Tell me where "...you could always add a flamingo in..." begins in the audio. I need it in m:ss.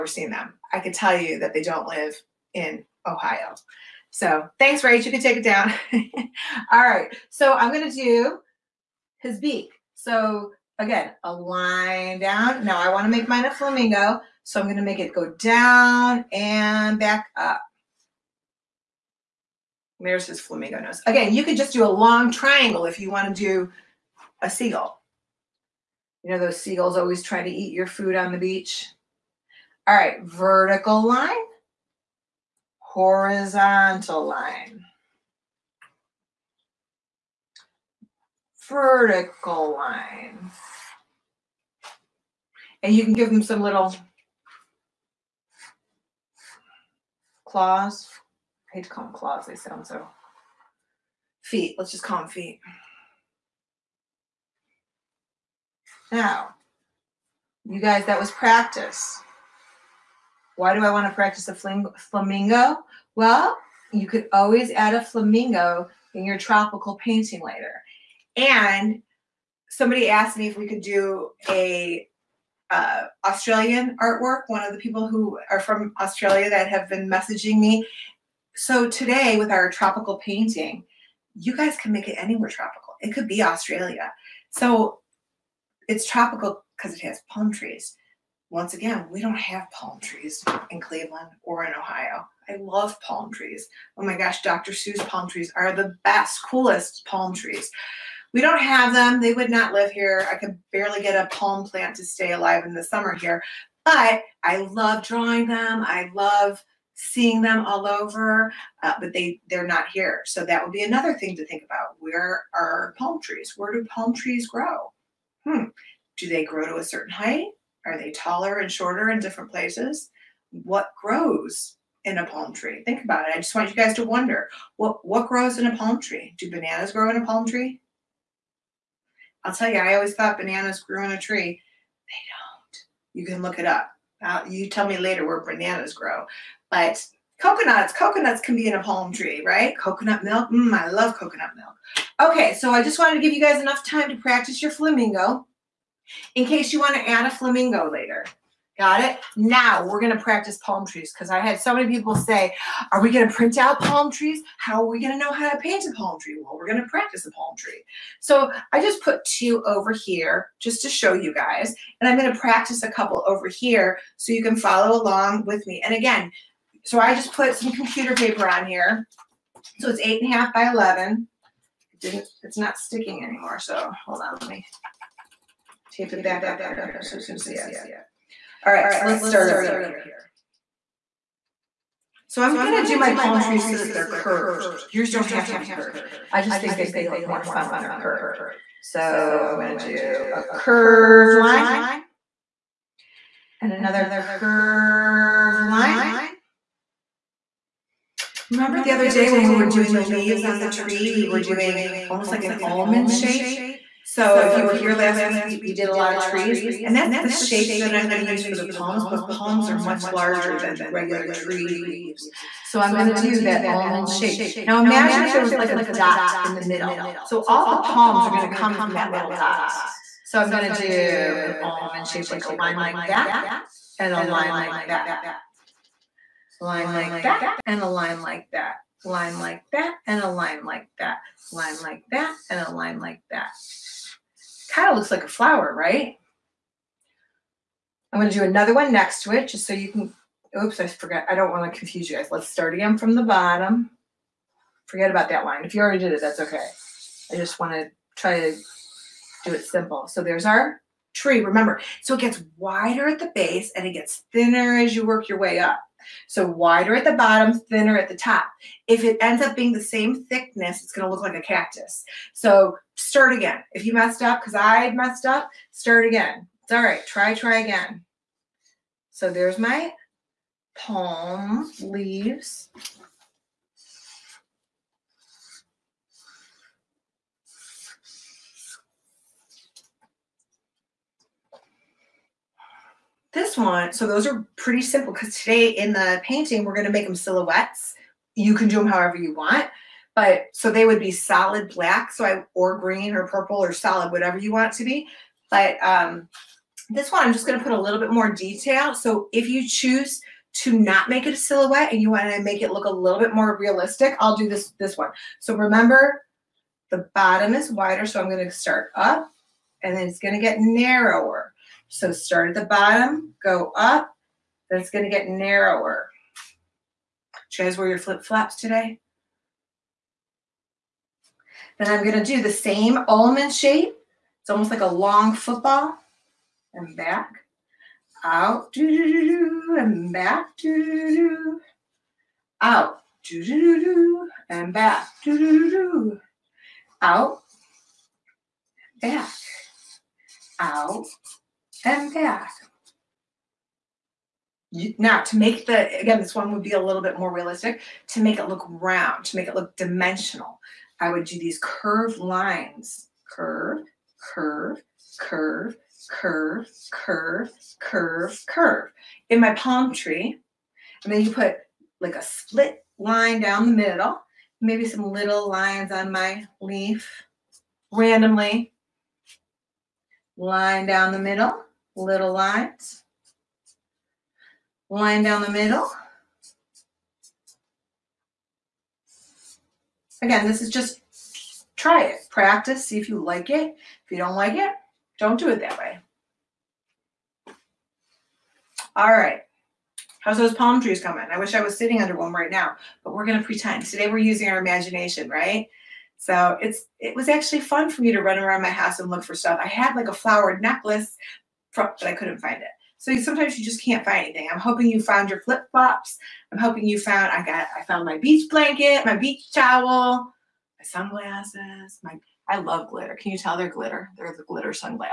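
1:03.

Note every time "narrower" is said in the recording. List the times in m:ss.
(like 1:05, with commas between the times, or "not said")
5:10, 5:15.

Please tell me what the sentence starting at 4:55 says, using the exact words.
But um, this one, I'm just going to put a little bit more detail.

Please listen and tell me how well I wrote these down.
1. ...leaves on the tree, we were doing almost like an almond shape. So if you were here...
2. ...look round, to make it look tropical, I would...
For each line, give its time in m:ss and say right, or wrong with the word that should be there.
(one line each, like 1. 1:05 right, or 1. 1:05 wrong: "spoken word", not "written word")
1. 3:20 right
2. 5:48 wrong: "dimensional", not "tropical".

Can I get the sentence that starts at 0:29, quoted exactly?
All right, vertical line, horizontal line.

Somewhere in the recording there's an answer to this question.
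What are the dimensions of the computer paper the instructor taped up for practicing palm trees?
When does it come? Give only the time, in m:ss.
2:50.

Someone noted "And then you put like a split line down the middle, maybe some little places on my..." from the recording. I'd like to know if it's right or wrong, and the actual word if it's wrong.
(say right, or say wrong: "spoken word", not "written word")
wrong: "lines", not "places".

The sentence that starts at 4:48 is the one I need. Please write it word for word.
You can do them however you want.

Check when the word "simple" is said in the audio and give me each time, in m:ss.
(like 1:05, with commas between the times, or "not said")
4:09, 4:44.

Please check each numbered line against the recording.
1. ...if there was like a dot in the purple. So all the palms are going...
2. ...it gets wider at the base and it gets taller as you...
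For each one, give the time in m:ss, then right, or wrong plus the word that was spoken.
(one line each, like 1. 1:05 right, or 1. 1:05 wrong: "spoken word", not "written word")
1. 3:35 wrong: "middle", not "purple"
2. 4:12 wrong: "thinner", not "taller".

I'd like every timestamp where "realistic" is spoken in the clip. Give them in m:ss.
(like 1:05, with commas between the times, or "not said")
5:03, 5:47.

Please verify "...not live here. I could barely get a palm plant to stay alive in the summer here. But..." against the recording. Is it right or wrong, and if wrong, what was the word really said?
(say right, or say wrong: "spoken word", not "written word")
right.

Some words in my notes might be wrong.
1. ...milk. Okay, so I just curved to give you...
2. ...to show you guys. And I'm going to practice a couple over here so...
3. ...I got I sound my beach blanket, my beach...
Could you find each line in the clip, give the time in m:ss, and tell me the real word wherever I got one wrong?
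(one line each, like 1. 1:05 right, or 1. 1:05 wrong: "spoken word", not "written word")
1. 2:21 wrong: "wanted", not "curved"
2. 2:40 right
3. 6:47 wrong: "found", not "sound".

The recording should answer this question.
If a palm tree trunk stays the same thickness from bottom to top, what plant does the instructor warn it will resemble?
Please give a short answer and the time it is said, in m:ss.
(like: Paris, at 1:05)
Cactus, at 4:21.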